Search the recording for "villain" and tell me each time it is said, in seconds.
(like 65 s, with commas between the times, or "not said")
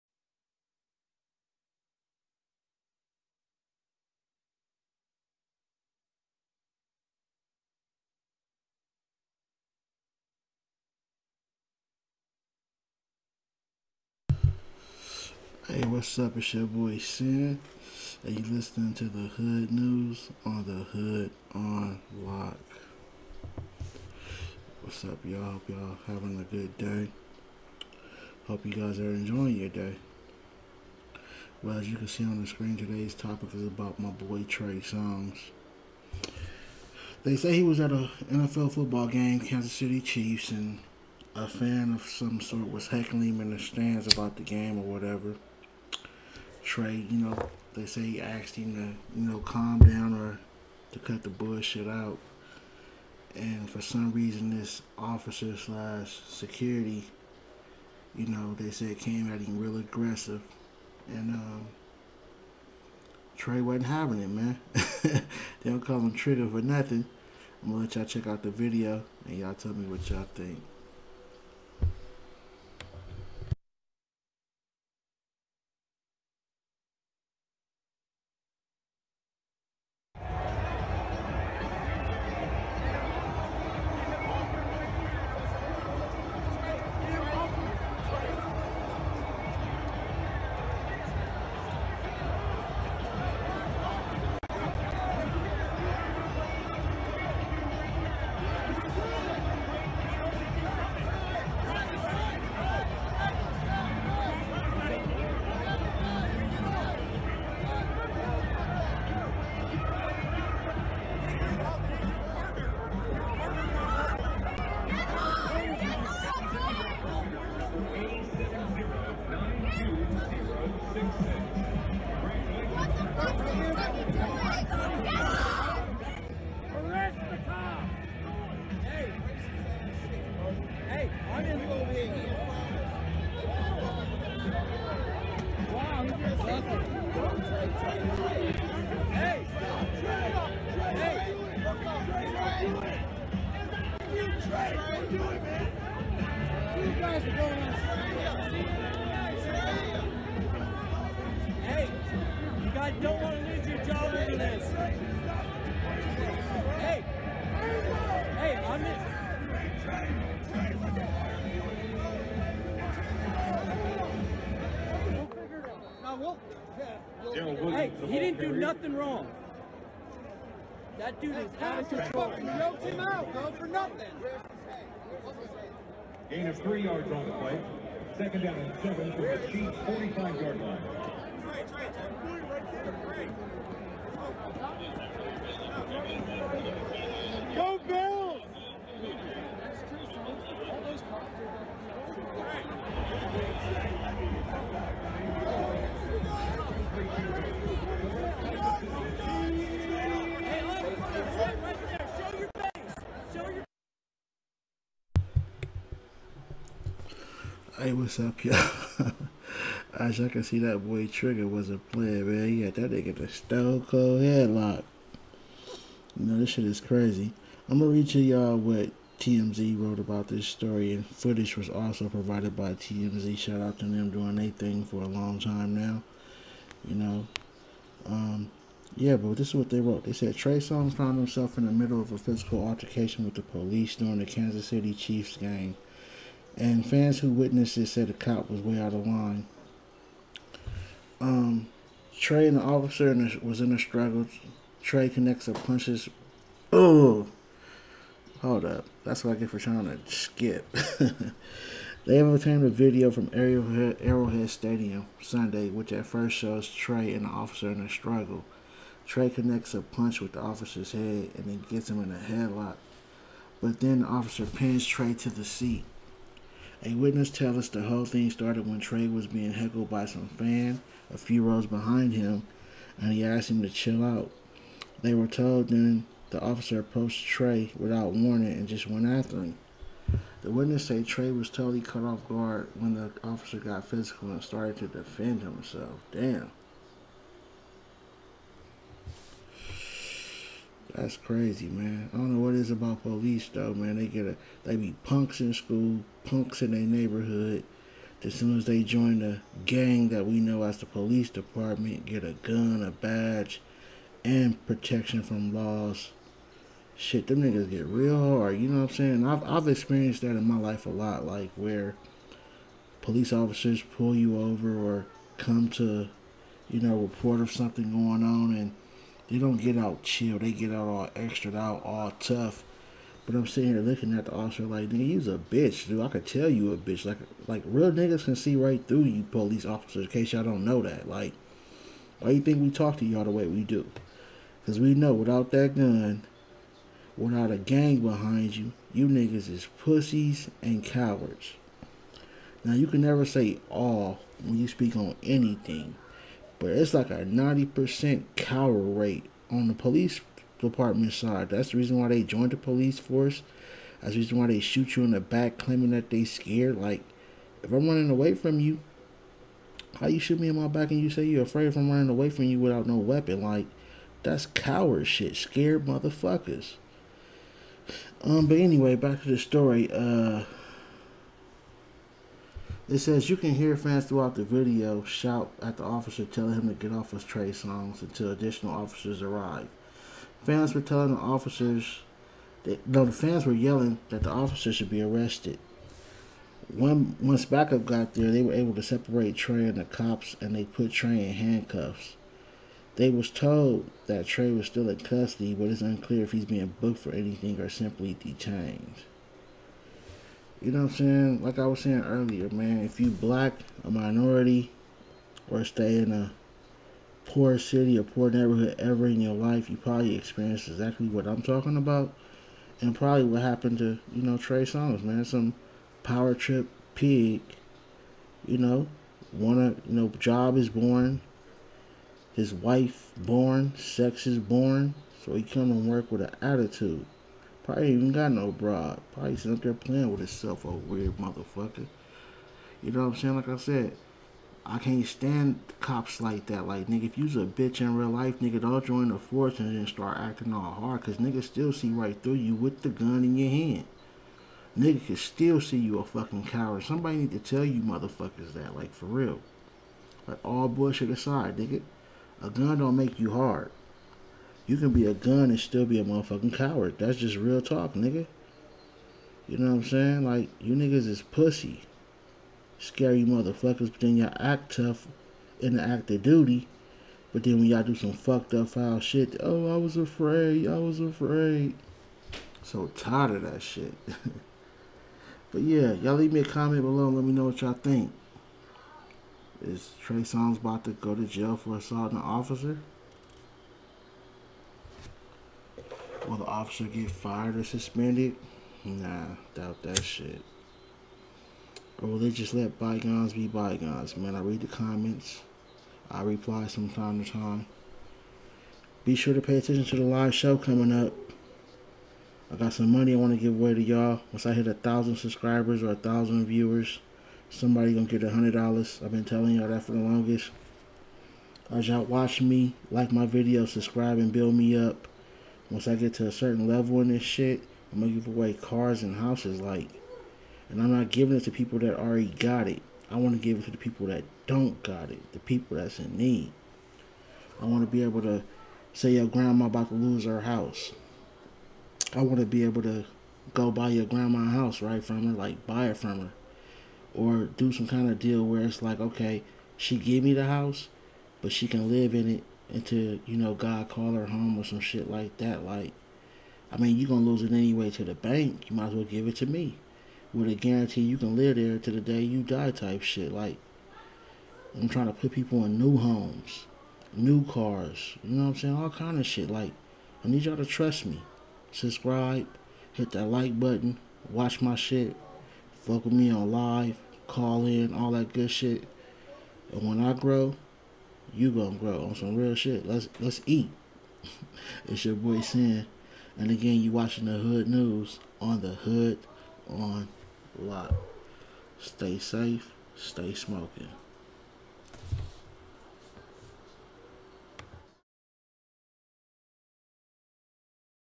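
not said.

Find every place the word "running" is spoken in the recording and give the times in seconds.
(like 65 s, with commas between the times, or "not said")
357 s, 361 s.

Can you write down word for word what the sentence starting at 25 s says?
Hope y'all having a good day.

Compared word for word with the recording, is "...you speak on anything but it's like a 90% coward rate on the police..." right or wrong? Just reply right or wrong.
right.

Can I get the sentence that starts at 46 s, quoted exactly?
Trey, you know, they say he asked him to, you know, calm down or to cut the bullshit out.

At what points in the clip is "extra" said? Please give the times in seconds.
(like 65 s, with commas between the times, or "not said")
321 s.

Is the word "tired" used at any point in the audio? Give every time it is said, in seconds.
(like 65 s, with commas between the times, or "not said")
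472 s.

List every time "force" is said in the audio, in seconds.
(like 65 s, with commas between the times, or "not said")
352 s, 439 s.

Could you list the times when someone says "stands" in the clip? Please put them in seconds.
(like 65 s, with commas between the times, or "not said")
43 s, 435 s.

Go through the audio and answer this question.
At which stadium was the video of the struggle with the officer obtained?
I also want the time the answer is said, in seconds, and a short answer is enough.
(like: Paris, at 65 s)
Arrowhead Stadium, at 254 s.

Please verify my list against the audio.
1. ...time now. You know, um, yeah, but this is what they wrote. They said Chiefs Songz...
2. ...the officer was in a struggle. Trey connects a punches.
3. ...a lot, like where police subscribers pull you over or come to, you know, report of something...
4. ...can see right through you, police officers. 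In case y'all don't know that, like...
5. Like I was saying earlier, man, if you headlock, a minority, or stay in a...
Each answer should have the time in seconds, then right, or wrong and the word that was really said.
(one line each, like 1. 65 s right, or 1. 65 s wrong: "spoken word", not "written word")
1. 225 s wrong: "Trey", not "Chiefs"
2. 242 s right
3. 310 s wrong: "officers", not "subscribers"
4. 328 s right
5. 401 s wrong: "black", not "headlock".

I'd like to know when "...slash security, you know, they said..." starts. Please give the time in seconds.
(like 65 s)
55 s.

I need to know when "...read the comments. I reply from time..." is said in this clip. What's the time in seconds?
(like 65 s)
494 s.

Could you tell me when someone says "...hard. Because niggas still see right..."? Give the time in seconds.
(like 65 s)
440 s.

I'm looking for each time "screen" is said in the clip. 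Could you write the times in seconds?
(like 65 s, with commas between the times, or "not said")
32 s.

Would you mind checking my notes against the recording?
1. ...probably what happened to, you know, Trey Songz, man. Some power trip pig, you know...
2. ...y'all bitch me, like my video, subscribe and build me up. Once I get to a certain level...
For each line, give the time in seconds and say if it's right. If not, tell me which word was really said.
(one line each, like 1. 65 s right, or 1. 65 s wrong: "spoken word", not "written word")
1. 412 s right
2. 511 s wrong: "watch", not "bitch".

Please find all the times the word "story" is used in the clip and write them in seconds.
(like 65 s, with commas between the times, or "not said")
220 s, 369 s.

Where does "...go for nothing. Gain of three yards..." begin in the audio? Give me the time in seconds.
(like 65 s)
173 s.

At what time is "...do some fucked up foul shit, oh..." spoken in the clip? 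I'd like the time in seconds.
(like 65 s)
467 s.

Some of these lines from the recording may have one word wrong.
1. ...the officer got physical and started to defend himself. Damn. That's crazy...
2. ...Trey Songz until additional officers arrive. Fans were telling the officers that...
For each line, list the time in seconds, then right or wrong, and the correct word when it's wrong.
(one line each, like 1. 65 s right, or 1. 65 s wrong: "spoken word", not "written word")
1. 282 s right
2. 377 s right.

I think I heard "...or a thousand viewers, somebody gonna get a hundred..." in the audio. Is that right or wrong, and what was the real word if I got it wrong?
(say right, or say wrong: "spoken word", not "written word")
right.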